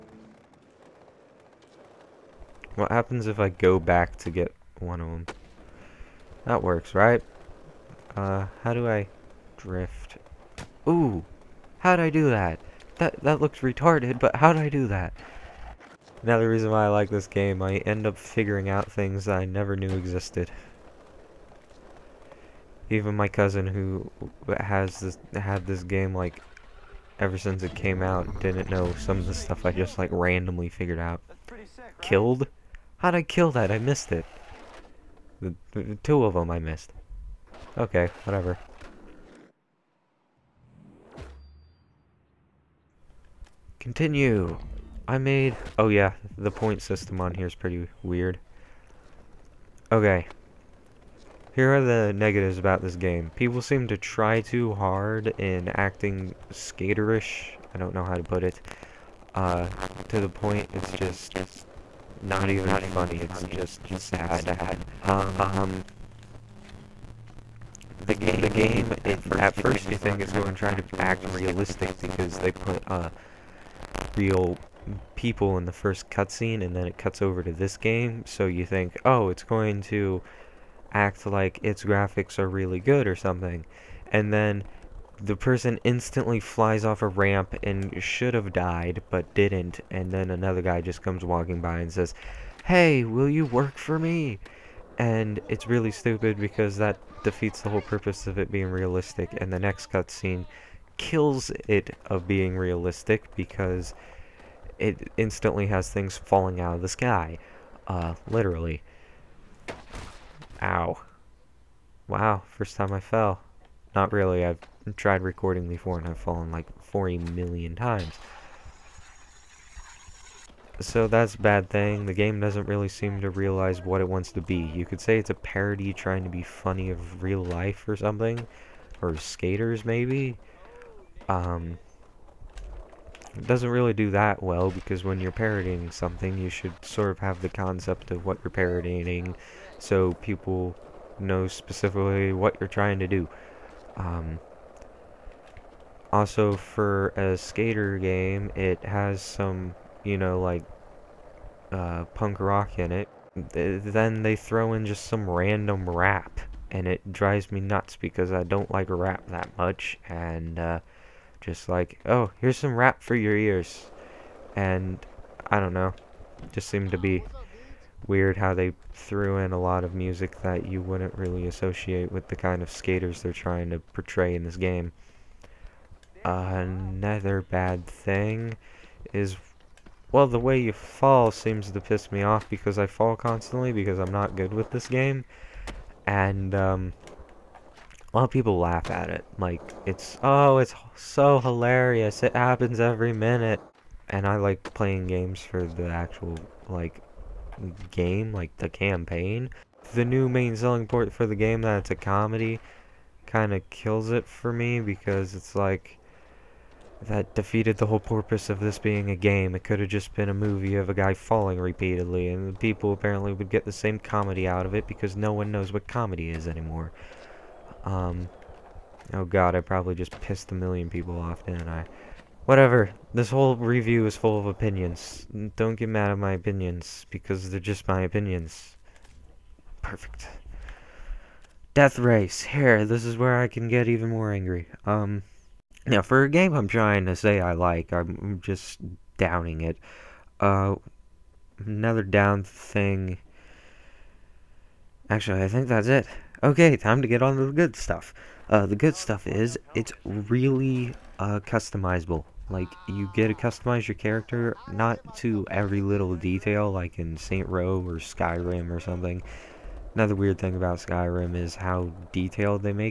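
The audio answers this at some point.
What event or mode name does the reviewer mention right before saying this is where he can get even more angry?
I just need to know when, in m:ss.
3:51.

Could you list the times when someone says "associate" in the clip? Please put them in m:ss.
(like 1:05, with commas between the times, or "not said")
2:51.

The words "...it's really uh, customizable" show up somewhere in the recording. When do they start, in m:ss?
4:09.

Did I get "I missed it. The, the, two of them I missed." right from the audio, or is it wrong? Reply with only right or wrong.
right.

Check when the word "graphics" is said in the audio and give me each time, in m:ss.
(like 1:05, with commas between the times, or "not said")
1:21.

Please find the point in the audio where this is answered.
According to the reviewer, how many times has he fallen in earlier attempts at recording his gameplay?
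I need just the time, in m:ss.
1:56.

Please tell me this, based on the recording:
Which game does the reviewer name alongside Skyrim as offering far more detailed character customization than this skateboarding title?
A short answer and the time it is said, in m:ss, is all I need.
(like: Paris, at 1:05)
Saint Row, at 4:17.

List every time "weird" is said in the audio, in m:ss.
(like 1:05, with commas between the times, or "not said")
0:48, 2:48, 4:20.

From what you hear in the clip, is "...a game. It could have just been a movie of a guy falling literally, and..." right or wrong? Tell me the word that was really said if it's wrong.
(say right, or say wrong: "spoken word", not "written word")
wrong: "repeatedly", not "literally".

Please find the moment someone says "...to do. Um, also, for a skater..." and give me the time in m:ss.
2:23.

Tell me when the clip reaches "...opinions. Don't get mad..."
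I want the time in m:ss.
3:44.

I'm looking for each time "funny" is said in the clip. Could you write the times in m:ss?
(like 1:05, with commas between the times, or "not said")
1:02, 2:06.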